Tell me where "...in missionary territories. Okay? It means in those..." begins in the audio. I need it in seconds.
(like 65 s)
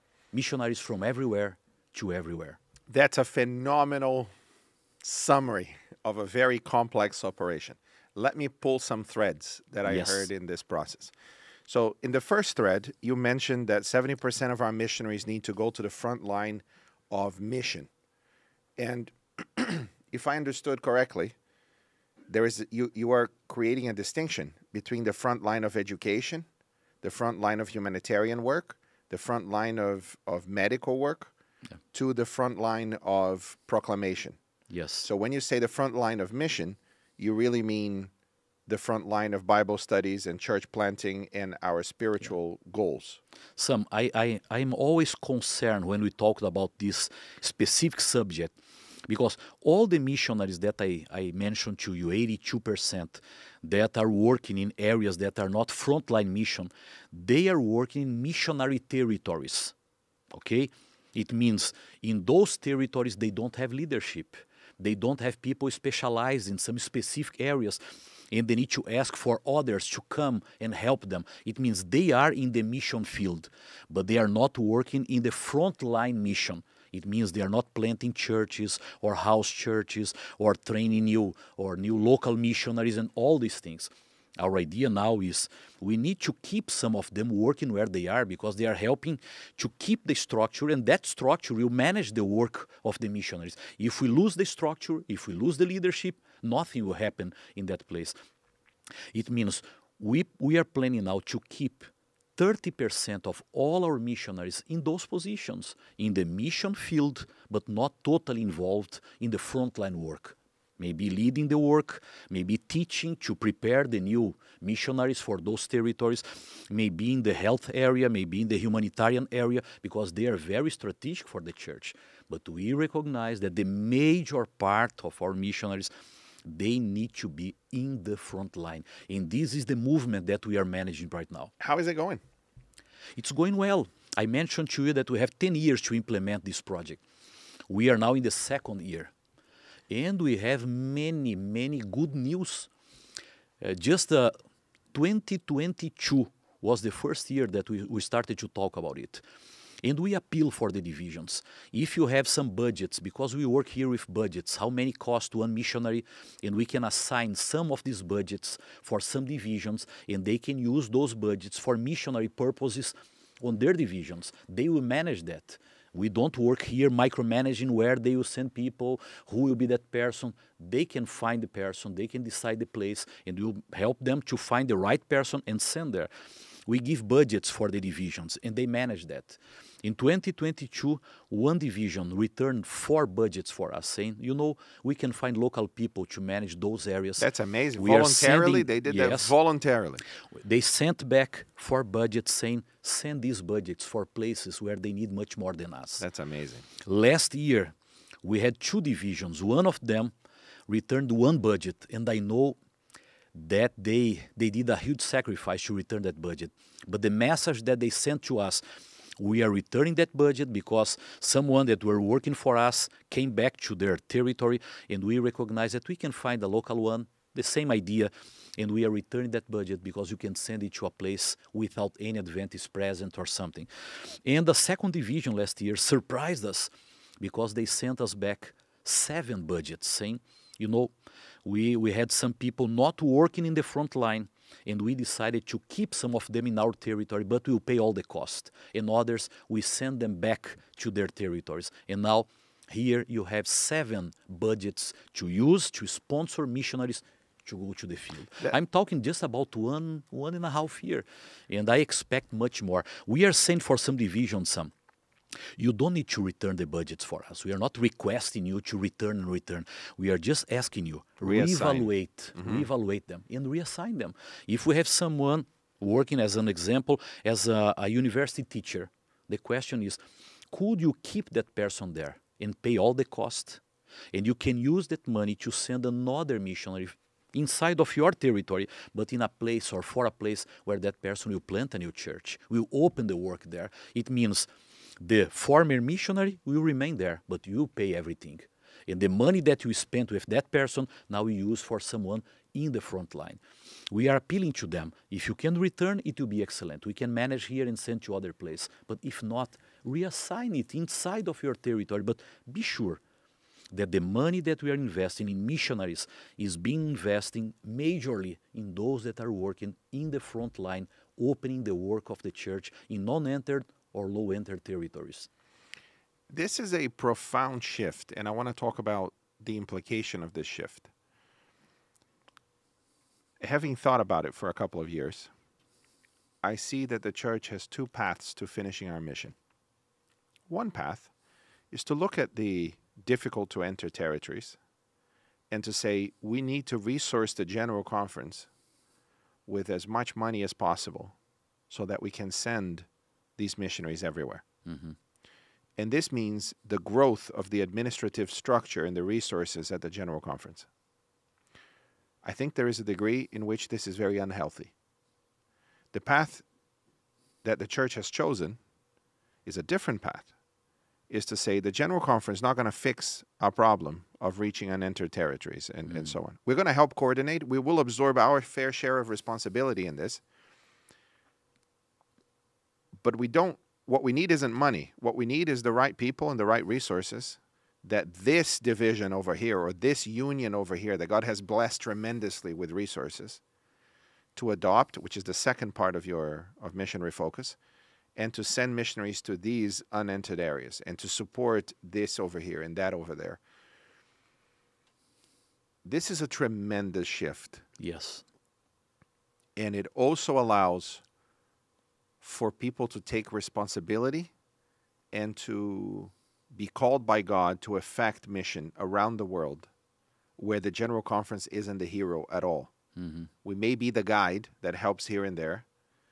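58 s.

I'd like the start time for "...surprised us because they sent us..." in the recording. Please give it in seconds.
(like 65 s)
225 s.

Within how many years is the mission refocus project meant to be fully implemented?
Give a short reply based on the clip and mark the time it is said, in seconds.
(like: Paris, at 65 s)
10 years, at 135 s.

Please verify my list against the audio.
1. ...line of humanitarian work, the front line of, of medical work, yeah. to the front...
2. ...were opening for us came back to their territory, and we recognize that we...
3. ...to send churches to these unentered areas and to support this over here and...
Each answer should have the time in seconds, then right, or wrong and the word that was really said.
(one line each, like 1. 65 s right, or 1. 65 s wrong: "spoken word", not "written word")
1. 27 s right
2. 211 s wrong: "working", not "opening"
3. 388 s wrong: "missionaries", not "churches".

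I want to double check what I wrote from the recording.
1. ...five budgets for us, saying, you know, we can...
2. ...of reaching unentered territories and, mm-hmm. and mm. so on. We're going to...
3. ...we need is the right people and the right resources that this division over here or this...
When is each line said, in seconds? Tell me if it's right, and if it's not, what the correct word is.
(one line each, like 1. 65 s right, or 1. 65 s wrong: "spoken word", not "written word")
1. 182 s wrong: "four", not "five"
2. 364 s right
3. 375 s right.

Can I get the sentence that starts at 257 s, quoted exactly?
We are not requesting you to return and return.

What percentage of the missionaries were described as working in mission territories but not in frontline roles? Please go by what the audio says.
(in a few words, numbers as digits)
82%.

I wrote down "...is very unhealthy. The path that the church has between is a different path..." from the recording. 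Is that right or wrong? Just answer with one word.
wrong.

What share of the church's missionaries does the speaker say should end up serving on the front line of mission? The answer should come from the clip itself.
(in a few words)
70%.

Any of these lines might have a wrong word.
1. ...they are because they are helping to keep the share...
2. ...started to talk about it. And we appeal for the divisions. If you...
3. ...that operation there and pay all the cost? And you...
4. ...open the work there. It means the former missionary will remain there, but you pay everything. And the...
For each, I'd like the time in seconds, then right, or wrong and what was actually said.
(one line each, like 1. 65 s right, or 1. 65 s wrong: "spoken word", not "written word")
1. 87 s wrong: "structure", not "share"
2. 147 s right
3. 271 s wrong: "person", not "operation"
4. 282 s right.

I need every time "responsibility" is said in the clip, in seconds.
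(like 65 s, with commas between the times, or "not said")
369 s, 403 s.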